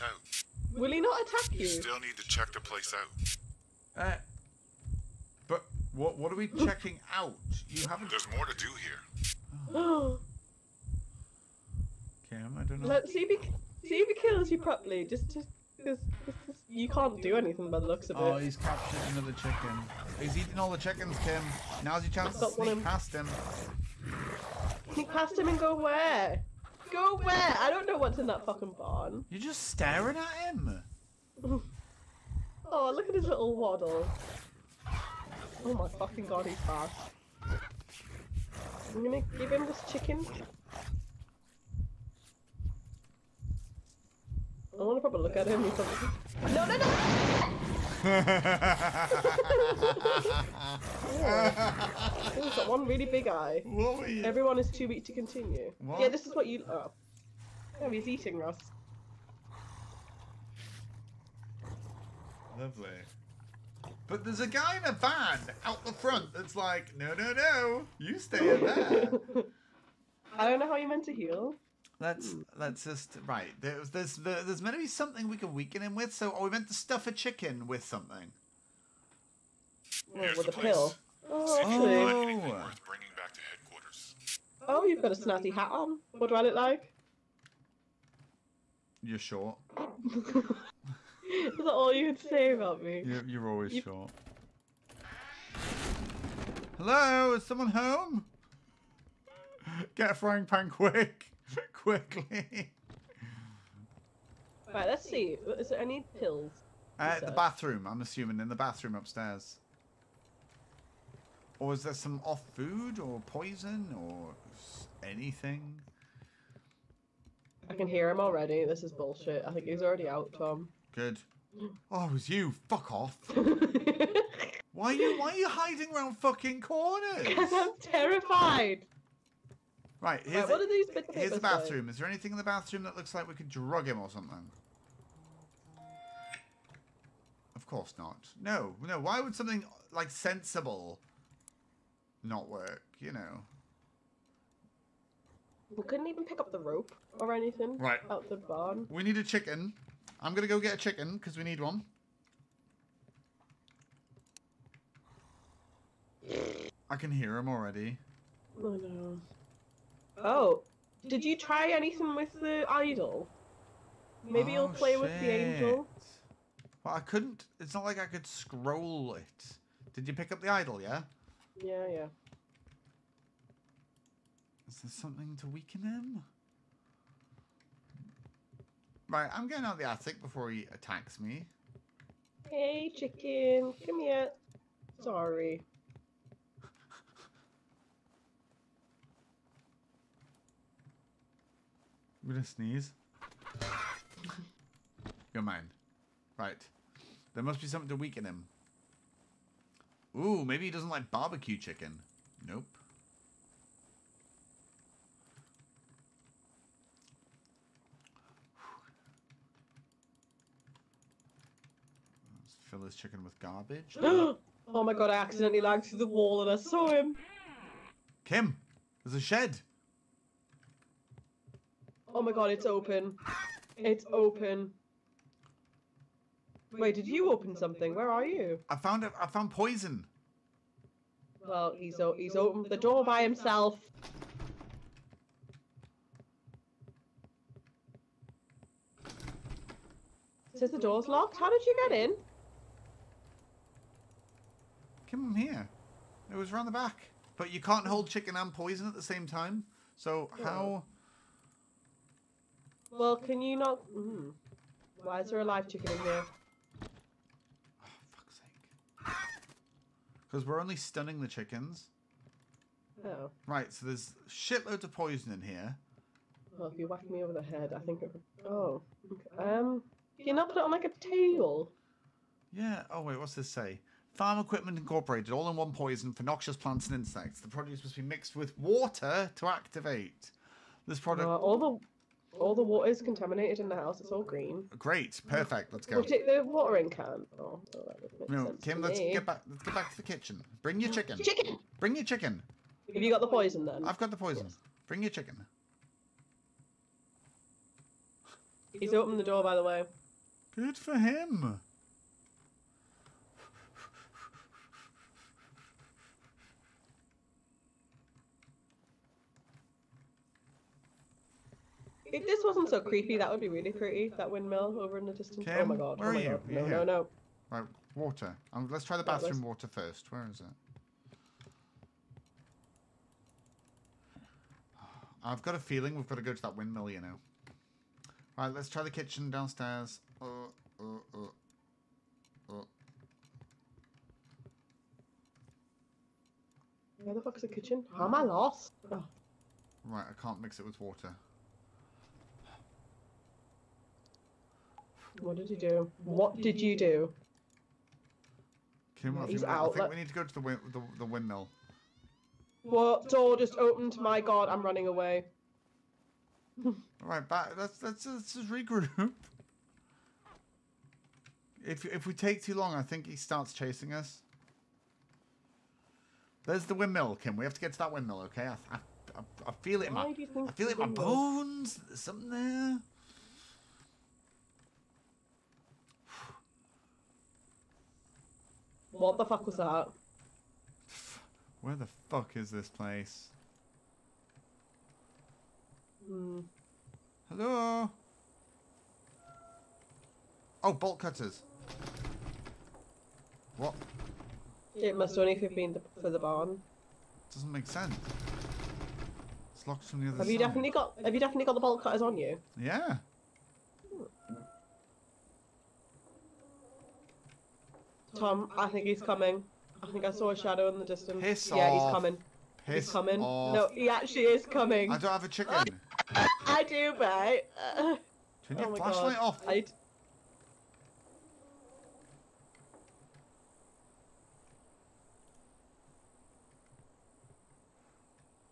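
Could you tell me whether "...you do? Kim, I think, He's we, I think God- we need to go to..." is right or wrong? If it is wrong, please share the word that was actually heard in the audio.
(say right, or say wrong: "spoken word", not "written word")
wrong: "Let", not "God".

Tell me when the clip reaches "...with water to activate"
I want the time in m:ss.
4:38.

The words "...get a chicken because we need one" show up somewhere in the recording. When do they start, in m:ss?
2:30.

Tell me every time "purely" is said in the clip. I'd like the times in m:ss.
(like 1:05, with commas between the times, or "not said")
not said.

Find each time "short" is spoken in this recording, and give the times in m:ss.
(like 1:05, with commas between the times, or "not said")
1:29, 1:33.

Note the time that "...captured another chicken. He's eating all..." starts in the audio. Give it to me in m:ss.
0:18.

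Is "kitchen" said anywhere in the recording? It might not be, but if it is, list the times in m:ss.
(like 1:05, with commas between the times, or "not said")
4:50, 5:28, 5:37.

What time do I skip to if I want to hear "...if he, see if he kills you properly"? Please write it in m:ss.
0:13.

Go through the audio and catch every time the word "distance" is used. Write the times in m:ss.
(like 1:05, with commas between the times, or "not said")
5:15, 6:50.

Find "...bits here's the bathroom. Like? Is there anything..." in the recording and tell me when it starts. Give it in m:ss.
2:10.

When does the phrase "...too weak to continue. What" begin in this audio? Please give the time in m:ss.
0:54.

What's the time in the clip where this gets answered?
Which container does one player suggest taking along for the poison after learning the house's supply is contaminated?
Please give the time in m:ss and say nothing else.
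4:46.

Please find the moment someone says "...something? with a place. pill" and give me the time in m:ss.
1:17.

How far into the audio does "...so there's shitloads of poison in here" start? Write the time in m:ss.
4:23.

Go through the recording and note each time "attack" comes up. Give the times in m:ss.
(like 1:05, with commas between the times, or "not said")
0:01, 3:00.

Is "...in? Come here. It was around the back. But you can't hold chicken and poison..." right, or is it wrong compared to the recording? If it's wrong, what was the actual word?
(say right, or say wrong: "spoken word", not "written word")
right.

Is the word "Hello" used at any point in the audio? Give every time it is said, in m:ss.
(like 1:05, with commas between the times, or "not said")
1:36, 6:27.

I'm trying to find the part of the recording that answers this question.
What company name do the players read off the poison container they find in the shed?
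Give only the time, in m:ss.
4:34.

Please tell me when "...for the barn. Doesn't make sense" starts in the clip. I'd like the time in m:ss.
6:36.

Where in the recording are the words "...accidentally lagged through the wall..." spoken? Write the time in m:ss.
3:35.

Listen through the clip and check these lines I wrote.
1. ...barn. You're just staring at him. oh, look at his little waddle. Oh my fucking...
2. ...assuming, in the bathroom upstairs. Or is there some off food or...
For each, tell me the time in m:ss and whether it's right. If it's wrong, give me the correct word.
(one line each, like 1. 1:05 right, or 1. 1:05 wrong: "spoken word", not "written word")
1. 0:28 right
2. 1:48 right.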